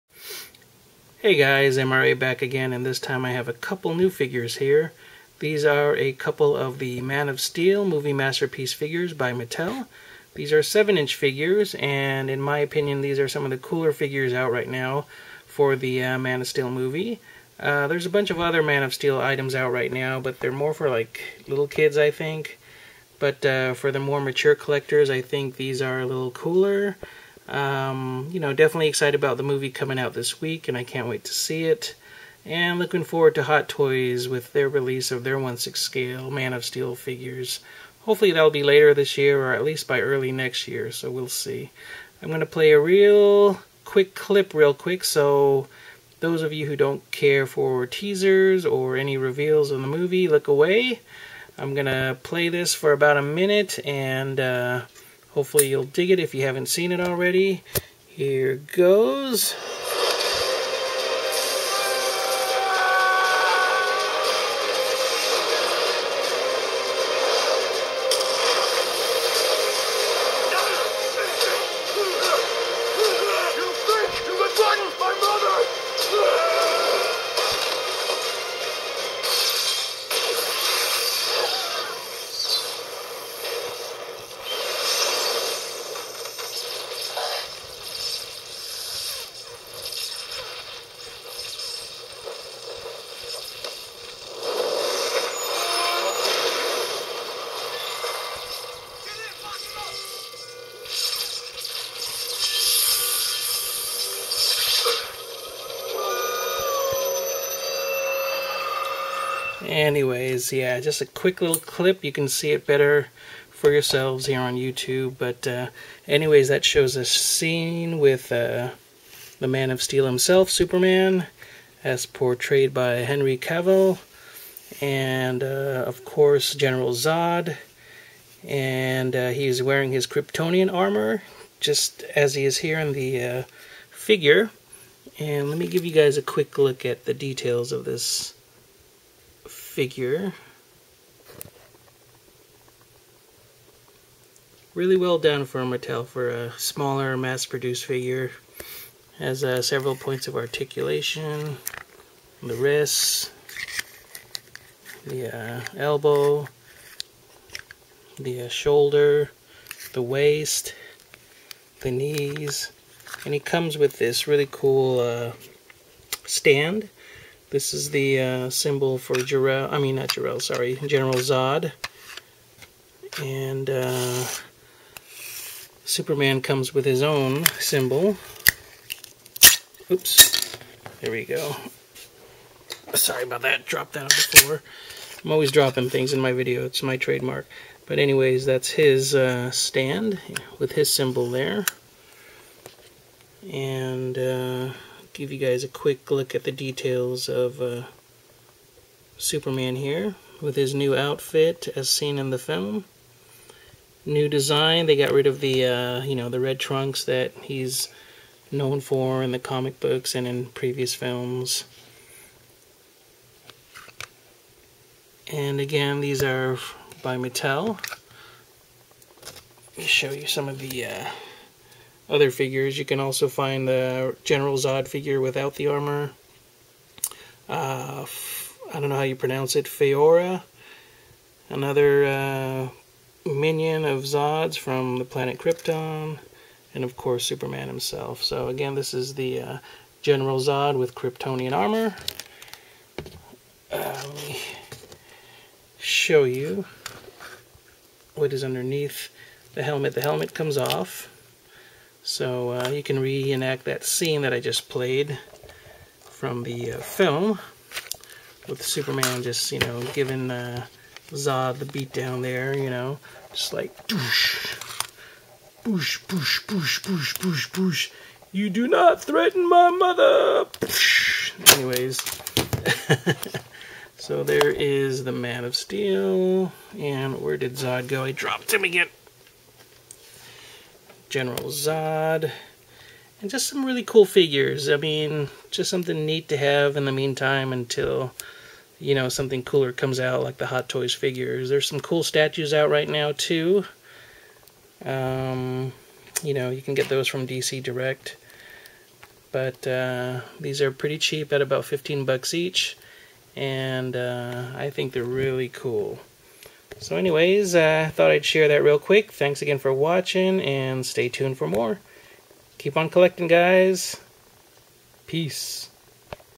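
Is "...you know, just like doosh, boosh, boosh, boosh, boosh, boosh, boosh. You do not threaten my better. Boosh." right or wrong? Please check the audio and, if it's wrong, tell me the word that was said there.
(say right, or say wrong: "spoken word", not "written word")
wrong: "mother", not "better".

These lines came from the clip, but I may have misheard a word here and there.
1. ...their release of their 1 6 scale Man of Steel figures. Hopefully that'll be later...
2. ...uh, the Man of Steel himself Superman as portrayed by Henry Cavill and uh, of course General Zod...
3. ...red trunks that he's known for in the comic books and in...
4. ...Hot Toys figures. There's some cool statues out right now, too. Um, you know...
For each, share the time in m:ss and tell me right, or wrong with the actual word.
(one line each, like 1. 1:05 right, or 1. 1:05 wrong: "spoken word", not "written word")
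1. 0:34 right
2. 1:58 right
3. 3:26 right
4. 4:50 right.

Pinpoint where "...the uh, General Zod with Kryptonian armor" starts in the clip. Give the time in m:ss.
3:59.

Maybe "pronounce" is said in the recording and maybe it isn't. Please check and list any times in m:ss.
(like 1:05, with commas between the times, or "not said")
3:49.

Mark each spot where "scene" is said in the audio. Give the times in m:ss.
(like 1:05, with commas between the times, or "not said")
1:57, 4:13.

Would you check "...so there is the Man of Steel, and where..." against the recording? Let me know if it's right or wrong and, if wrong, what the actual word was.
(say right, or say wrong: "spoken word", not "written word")
right.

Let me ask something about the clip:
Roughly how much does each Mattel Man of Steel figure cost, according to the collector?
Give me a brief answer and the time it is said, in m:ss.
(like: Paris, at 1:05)
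$15, at 5:01.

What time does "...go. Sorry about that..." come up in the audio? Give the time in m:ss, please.
3:01.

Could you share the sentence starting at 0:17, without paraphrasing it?
Uh, there's a bunch of other Man of Steel items out right now, but they're more for, like, little kids, I think.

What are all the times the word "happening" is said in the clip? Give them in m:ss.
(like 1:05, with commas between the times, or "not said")
not said.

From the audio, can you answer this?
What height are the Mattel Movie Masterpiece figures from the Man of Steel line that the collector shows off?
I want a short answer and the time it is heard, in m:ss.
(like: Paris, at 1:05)
7 inches, at 0:10.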